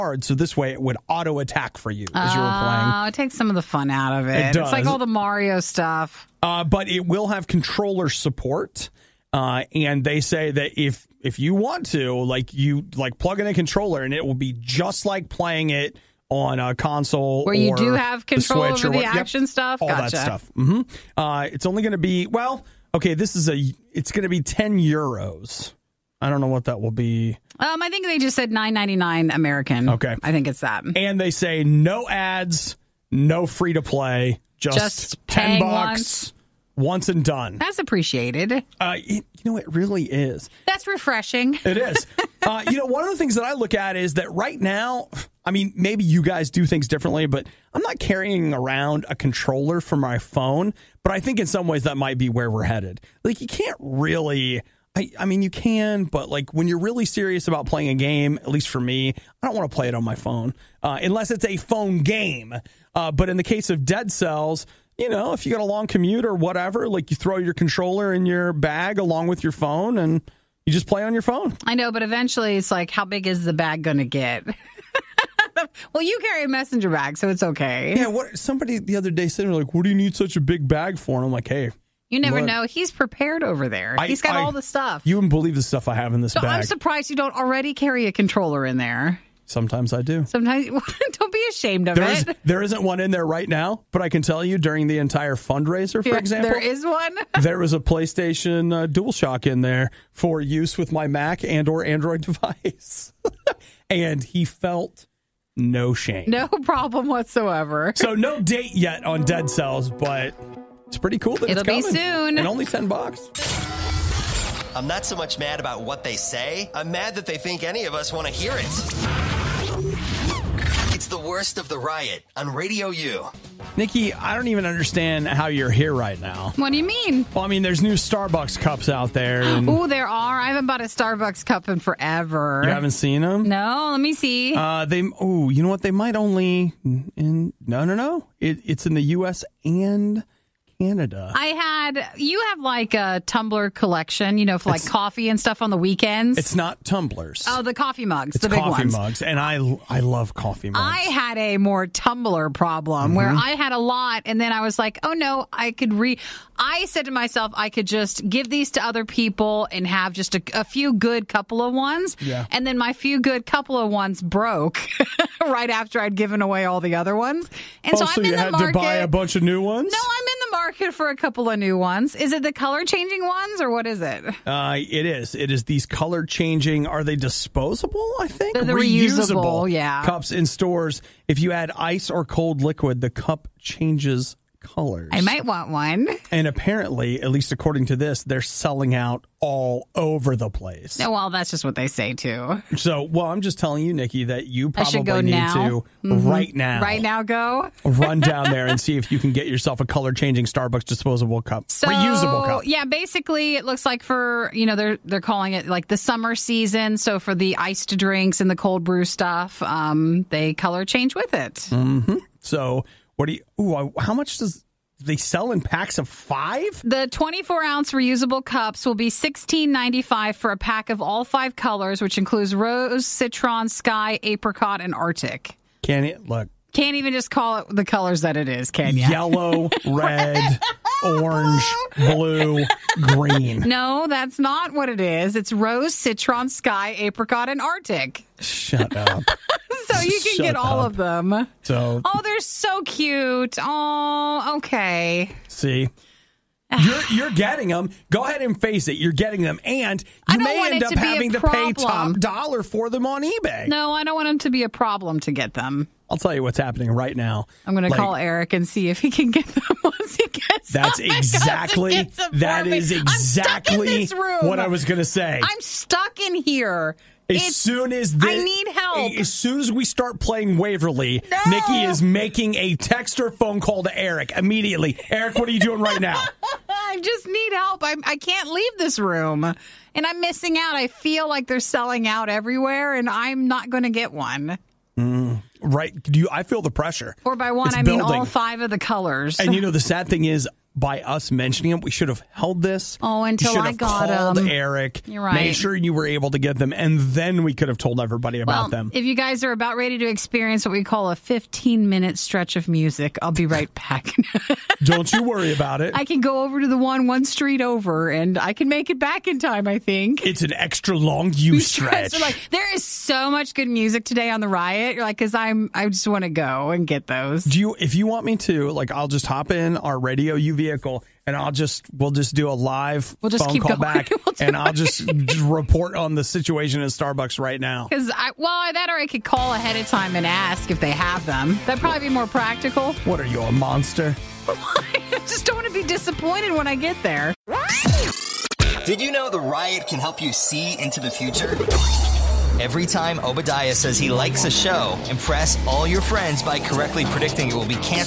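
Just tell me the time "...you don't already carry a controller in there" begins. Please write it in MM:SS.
01:27.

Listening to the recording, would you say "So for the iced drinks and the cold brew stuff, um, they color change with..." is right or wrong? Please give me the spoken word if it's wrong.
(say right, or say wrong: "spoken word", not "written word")
right.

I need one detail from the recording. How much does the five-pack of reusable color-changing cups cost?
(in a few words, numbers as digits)
$16.95.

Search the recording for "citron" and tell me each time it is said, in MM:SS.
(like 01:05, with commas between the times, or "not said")
03:43, 03:55.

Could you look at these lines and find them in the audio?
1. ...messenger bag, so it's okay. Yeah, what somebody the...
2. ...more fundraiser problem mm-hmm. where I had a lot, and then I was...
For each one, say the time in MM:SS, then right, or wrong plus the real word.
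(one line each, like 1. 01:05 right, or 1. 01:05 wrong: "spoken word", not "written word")
1. 01:16 right
2. 02:31 wrong: "tumbler", not "fundraiser".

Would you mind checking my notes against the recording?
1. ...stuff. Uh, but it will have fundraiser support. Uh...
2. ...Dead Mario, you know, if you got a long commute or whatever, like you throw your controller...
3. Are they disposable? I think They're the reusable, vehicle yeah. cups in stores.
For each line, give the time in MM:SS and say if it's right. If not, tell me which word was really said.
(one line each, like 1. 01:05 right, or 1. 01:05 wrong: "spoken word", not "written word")
1. 00:05 wrong: "controller", not "fundraiser"
2. 01:03 wrong: "Cells", not "Mario"
3. 02:56 wrong: "reusable", not "vehicle".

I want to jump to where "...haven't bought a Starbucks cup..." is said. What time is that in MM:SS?
02:10.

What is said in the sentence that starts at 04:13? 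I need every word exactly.
No, I don't want them to be a problem to get them.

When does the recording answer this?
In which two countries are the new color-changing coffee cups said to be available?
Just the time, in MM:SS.
02:19.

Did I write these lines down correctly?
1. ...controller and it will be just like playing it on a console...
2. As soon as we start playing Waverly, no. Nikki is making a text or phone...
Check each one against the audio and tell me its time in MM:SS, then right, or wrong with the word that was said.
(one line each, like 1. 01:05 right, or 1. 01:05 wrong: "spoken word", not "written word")
1. 00:13 right
2. 04:29 right.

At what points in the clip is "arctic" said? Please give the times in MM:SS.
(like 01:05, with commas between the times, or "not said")
03:44, 03:57.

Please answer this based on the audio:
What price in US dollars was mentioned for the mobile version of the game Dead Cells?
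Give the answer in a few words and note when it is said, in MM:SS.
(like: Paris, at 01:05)
$9.99, at 00:28.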